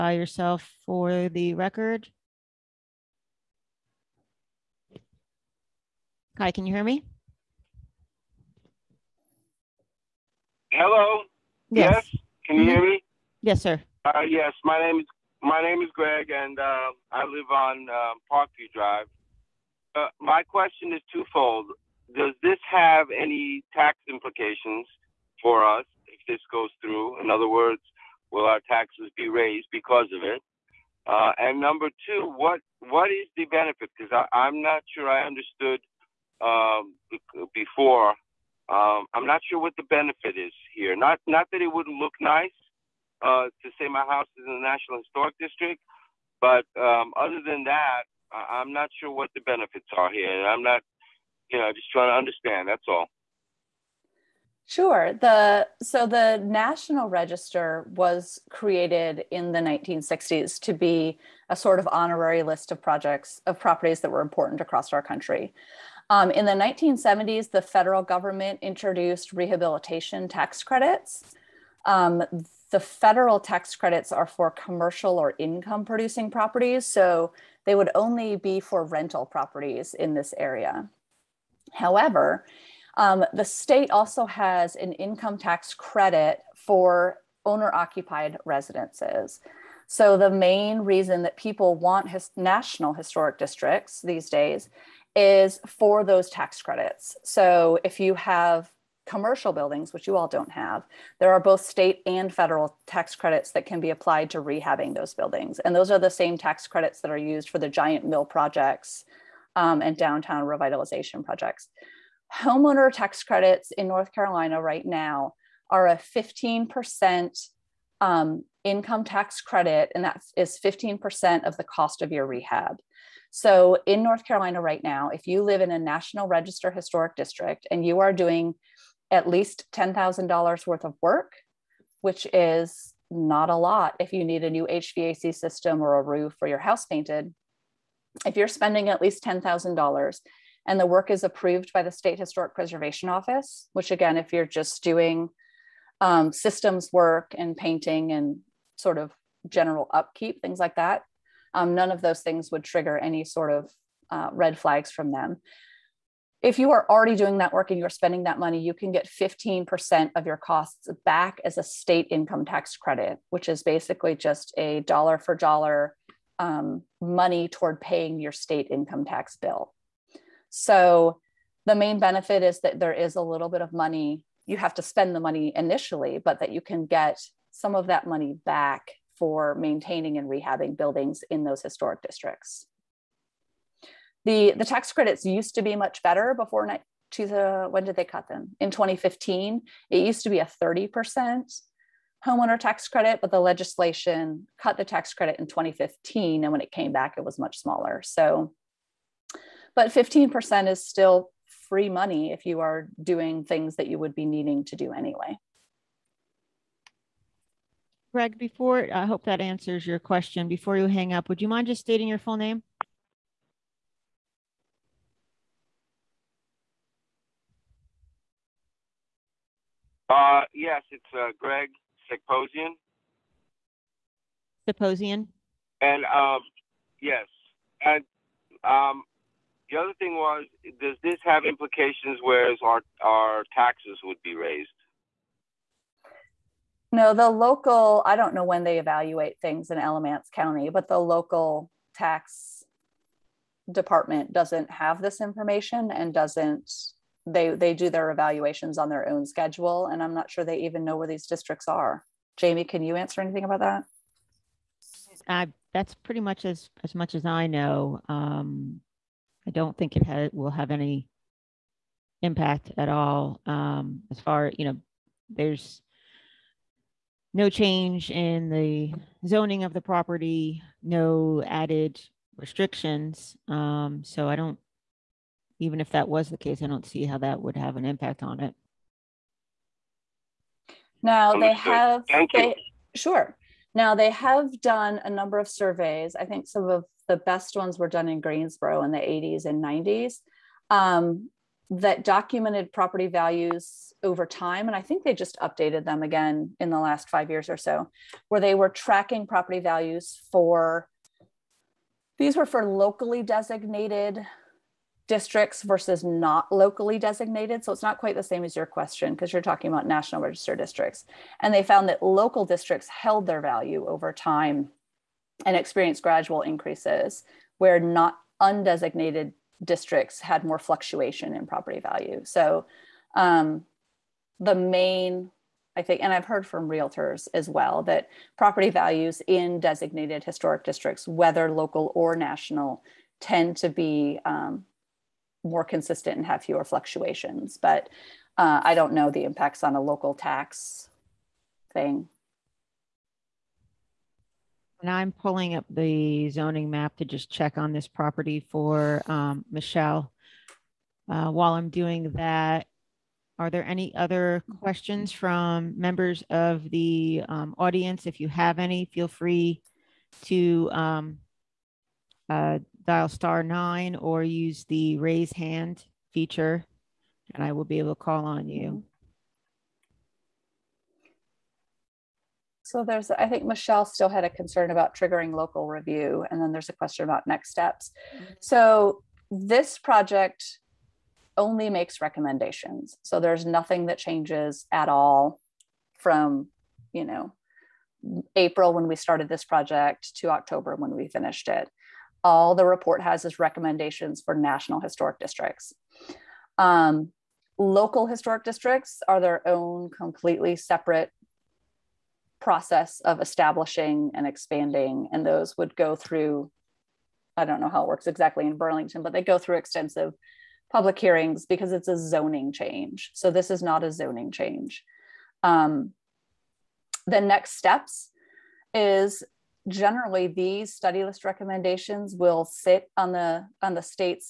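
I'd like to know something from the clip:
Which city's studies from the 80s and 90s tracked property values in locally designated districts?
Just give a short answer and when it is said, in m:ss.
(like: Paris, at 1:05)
Greensboro, at 4:48.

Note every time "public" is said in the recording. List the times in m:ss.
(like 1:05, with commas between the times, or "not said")
6:50.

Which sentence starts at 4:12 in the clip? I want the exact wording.
Jamie, can you answer anything about that?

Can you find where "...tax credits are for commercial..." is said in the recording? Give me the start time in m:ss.
1:13.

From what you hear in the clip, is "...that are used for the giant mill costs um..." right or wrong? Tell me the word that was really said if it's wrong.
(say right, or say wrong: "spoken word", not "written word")
wrong: "projects", not "costs".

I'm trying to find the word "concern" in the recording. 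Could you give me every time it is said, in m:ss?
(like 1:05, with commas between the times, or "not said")
6:14.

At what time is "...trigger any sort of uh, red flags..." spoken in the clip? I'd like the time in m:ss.
2:32.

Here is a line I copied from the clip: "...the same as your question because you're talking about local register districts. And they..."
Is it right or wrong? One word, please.
wrong.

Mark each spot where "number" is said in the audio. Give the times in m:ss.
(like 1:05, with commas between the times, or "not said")
0:31, 4:45.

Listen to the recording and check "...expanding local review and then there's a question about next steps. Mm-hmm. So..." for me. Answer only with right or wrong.
wrong.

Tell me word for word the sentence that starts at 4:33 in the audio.
Um, so I don't, even if that was the case, I don't see how that would have an impact on it.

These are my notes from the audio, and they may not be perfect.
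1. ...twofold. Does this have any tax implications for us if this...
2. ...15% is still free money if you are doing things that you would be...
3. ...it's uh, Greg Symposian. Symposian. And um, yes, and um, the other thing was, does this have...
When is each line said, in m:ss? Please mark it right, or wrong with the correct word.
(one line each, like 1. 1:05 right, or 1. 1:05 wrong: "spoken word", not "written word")
1. 0:21 right
2. 3:19 right
3. 3:40 right.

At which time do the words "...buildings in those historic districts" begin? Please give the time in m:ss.
3:00.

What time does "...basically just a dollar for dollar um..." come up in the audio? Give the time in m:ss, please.
2:43.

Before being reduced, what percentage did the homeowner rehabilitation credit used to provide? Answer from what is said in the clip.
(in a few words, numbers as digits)
30%.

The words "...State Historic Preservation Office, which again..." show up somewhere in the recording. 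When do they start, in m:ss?
2:21.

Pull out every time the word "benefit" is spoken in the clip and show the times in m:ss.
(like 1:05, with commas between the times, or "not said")
0:33, 0:39, 0:49, 2:51.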